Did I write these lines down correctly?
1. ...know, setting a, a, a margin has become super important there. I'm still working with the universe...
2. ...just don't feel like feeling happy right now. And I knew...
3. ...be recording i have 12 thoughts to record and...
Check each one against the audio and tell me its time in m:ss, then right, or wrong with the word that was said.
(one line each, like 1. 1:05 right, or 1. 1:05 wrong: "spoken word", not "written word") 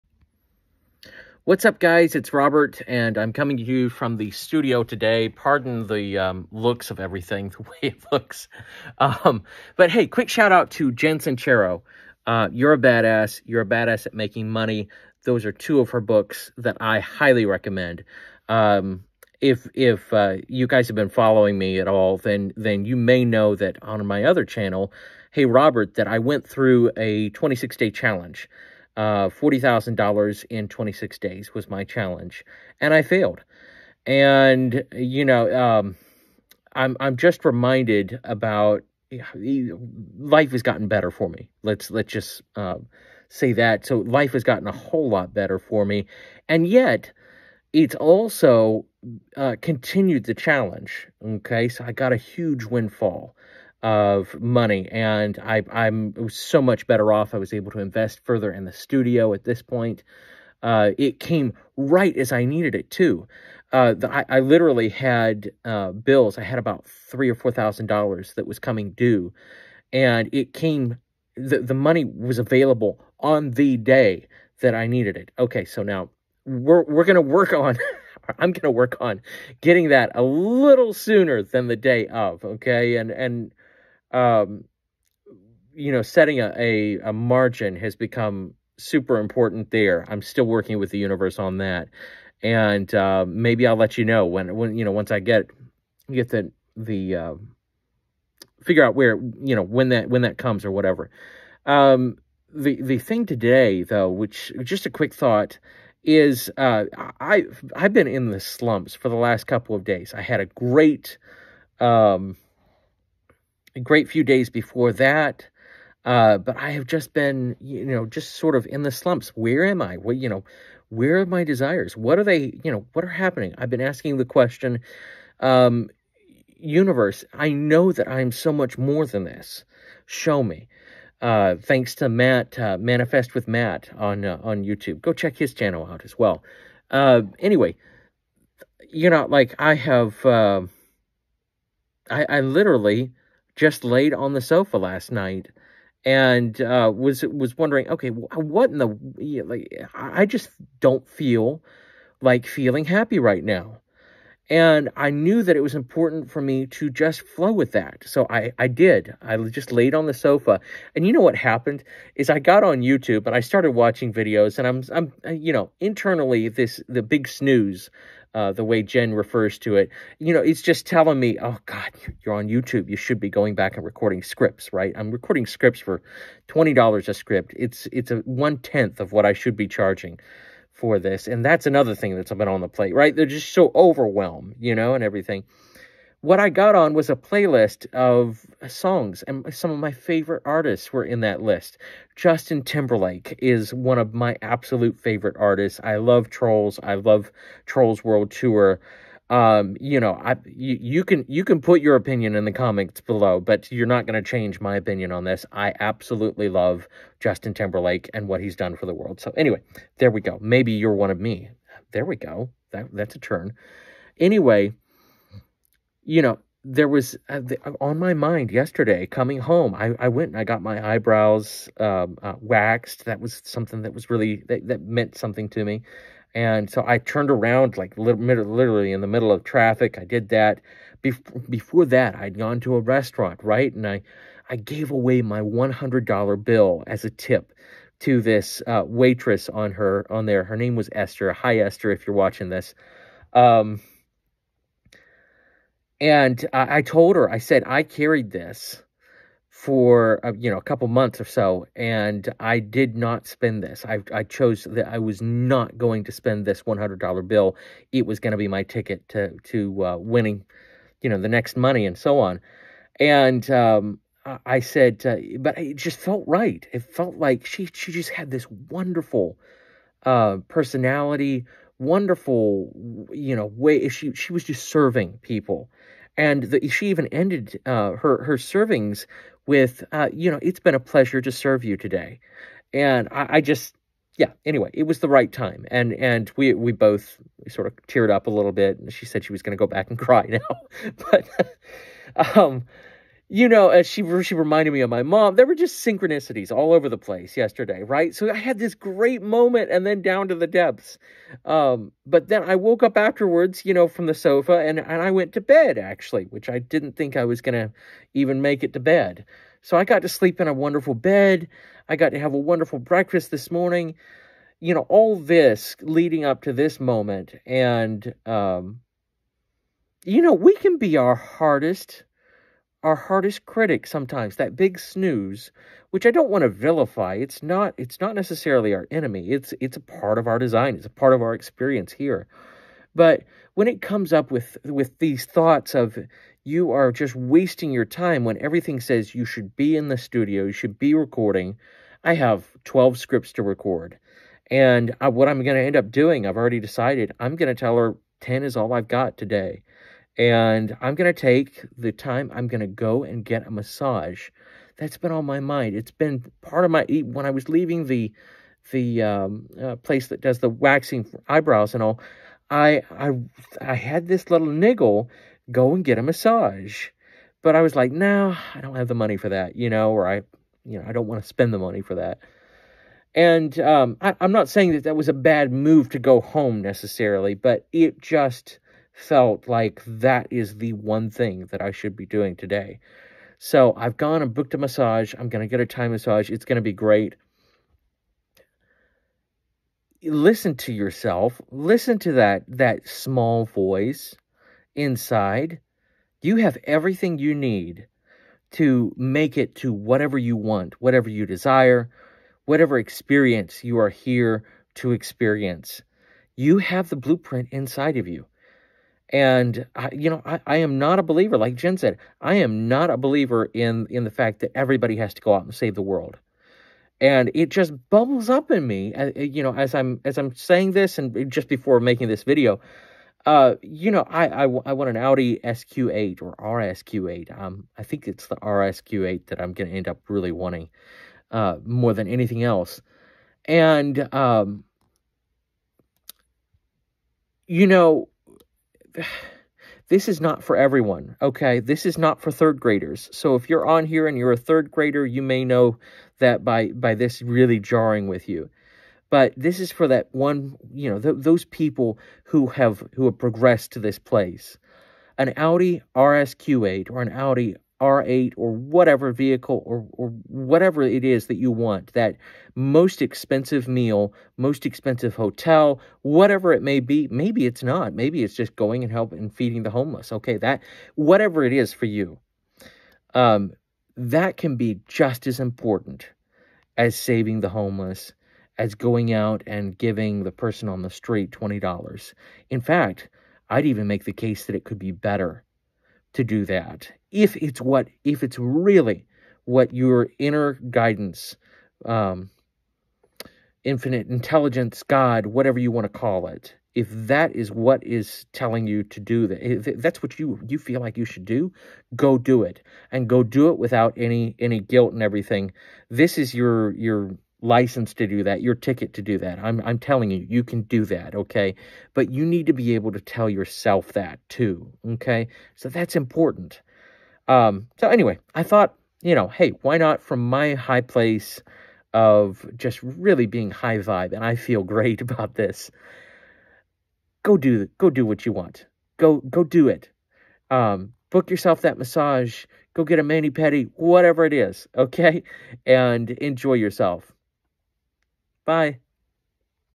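1. 1:25 right
2. 2:30 right
3. 5:40 wrong: "scripts", not "thoughts".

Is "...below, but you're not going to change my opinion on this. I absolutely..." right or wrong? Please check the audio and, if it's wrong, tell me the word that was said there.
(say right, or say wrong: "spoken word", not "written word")
right.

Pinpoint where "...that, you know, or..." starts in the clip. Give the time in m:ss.
6:09.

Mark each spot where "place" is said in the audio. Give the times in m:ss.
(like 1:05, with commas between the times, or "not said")
4:56, 5:59, 7:33, 8:40.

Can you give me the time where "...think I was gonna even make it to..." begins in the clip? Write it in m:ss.
5:06.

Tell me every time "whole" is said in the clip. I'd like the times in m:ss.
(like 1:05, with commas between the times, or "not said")
0:44.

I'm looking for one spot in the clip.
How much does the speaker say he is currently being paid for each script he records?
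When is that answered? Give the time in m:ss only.
2:56.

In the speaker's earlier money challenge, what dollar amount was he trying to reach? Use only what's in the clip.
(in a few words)
$40,000.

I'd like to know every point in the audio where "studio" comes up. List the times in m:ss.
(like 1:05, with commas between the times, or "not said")
0:04, 0:58, 5:39.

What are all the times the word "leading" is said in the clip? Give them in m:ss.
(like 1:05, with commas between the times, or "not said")
5:15.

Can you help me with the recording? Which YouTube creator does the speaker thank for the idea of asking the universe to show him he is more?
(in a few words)
Manifest with Matt.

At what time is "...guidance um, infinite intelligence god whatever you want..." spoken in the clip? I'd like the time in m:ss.
8:10.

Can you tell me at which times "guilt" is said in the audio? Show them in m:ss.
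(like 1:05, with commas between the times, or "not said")
8:24.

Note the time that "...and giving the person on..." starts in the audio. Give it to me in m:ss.
7:59.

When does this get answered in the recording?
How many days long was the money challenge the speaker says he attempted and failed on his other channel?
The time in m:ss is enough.
0:27.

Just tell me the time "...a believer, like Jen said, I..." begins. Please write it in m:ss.
6:50.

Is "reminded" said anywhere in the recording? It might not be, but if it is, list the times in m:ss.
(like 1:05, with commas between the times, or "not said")
0:37, 4:54.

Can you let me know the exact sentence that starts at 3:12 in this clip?
Justin Timberlake is one of my absolute favorite artists.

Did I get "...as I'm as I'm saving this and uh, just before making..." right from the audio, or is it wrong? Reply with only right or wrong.
wrong.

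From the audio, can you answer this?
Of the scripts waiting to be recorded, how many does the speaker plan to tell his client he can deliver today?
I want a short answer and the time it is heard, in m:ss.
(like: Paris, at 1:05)
10, at 5:48.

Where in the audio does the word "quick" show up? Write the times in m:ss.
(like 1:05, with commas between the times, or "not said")
0:10, 1:44.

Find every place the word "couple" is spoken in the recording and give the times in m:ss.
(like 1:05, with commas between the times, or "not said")
1:49, 4:10.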